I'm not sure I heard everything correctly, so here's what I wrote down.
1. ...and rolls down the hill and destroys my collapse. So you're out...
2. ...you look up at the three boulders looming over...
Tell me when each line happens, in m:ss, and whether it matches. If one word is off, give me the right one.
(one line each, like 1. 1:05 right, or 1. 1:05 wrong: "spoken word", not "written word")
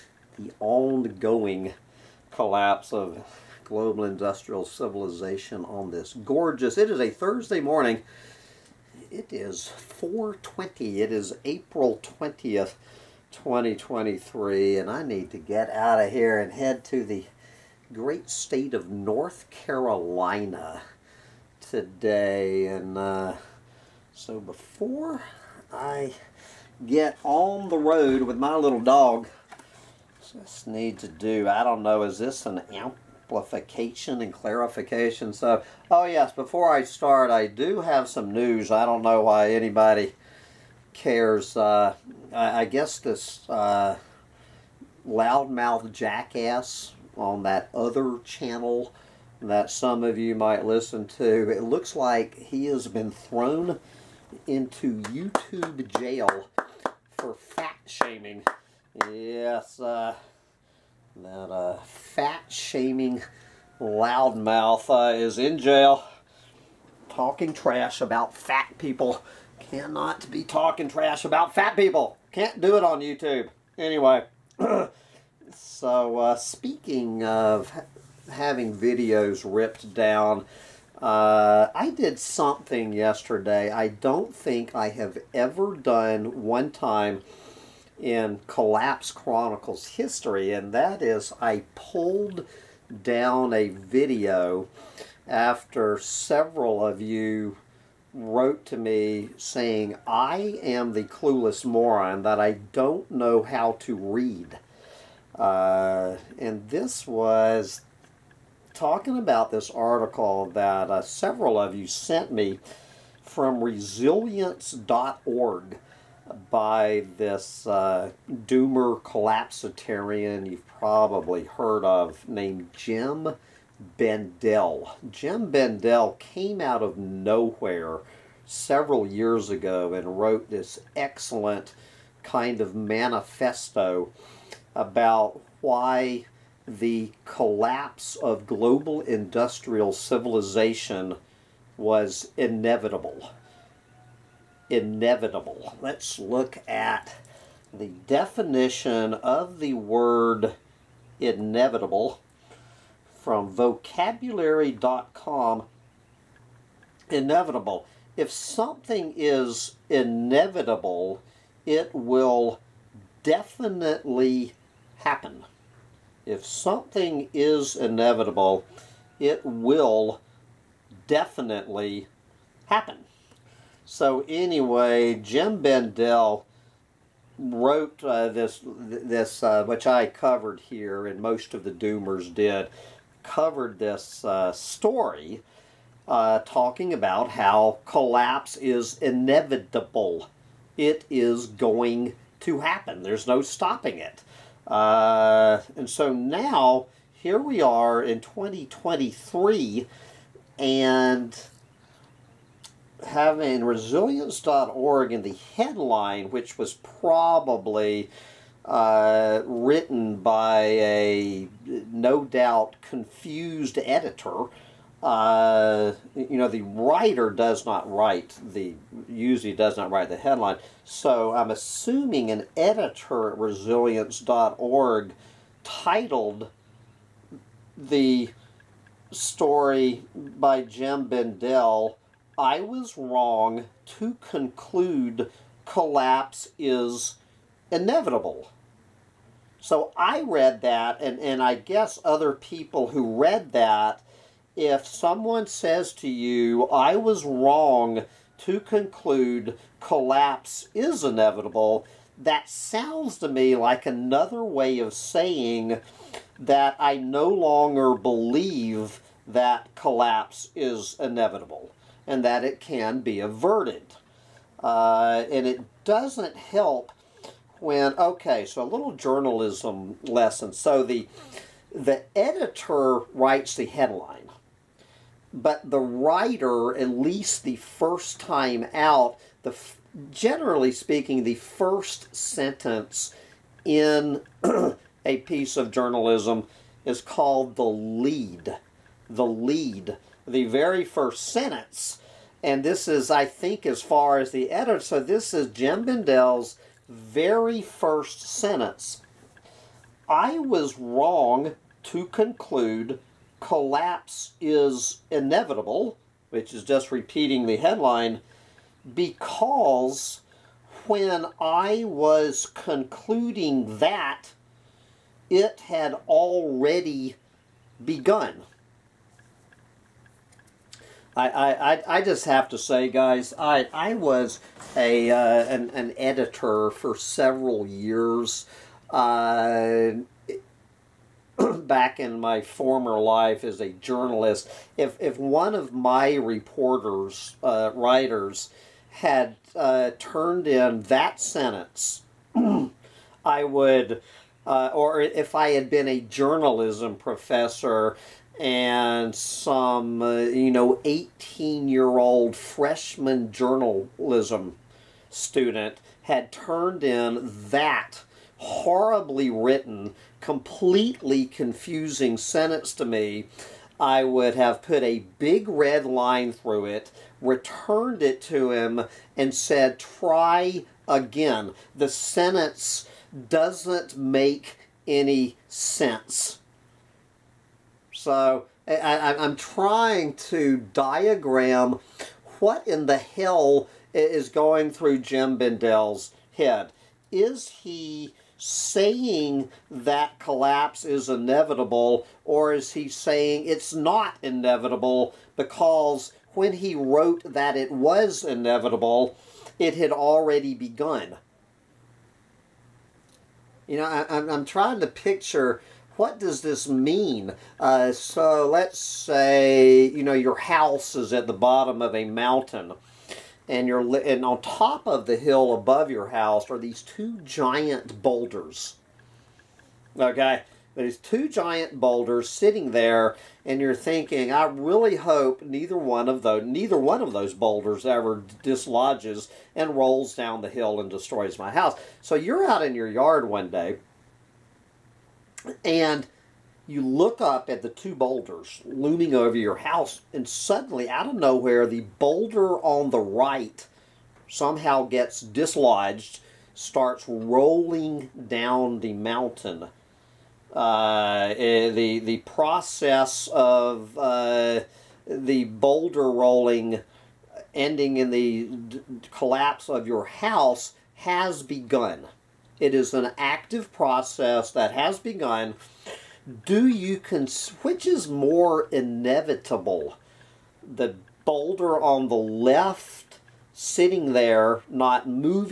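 1. 7:09 wrong: "house", not "collapse"
2. 7:16 wrong: "two", not "three".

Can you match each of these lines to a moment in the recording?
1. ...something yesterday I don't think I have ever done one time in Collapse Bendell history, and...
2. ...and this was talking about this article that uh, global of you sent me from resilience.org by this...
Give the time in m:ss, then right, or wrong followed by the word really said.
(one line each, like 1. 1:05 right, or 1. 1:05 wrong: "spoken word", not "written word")
1. 1:22 wrong: "Chronicles", not "Bendell"
2. 1:46 wrong: "several", not "global".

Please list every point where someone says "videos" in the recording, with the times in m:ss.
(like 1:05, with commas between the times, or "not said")
1:18, 1:33.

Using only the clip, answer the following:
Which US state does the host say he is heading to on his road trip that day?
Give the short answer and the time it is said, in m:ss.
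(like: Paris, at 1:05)
North Carolina, at 0:18.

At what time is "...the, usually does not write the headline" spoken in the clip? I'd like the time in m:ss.
3:38.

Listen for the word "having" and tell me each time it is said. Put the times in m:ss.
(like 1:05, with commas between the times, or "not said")
1:18, 3:23.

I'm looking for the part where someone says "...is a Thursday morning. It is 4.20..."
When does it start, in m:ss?
0:06.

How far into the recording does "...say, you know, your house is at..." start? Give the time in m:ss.
6:48.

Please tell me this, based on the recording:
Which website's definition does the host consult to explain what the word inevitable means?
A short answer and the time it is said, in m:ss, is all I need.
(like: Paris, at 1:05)
vocabulary.com, at 2:33.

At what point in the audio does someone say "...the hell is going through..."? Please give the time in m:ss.
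6:22.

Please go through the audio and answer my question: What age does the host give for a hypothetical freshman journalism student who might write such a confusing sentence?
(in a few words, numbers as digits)
18.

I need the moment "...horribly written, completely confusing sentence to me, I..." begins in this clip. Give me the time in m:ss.
5:58.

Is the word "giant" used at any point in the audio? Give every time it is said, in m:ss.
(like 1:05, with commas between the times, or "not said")
6:57, 7:01.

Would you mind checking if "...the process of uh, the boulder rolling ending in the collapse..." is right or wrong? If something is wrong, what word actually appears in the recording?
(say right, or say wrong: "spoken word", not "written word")
right.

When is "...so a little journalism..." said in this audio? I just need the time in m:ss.
4:28.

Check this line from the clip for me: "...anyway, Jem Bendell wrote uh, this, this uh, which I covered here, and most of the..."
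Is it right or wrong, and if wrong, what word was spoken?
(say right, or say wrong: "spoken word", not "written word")
right.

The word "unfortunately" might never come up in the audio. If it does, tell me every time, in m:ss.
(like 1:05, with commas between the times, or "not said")
not said.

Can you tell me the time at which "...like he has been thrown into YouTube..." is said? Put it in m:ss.
0:51.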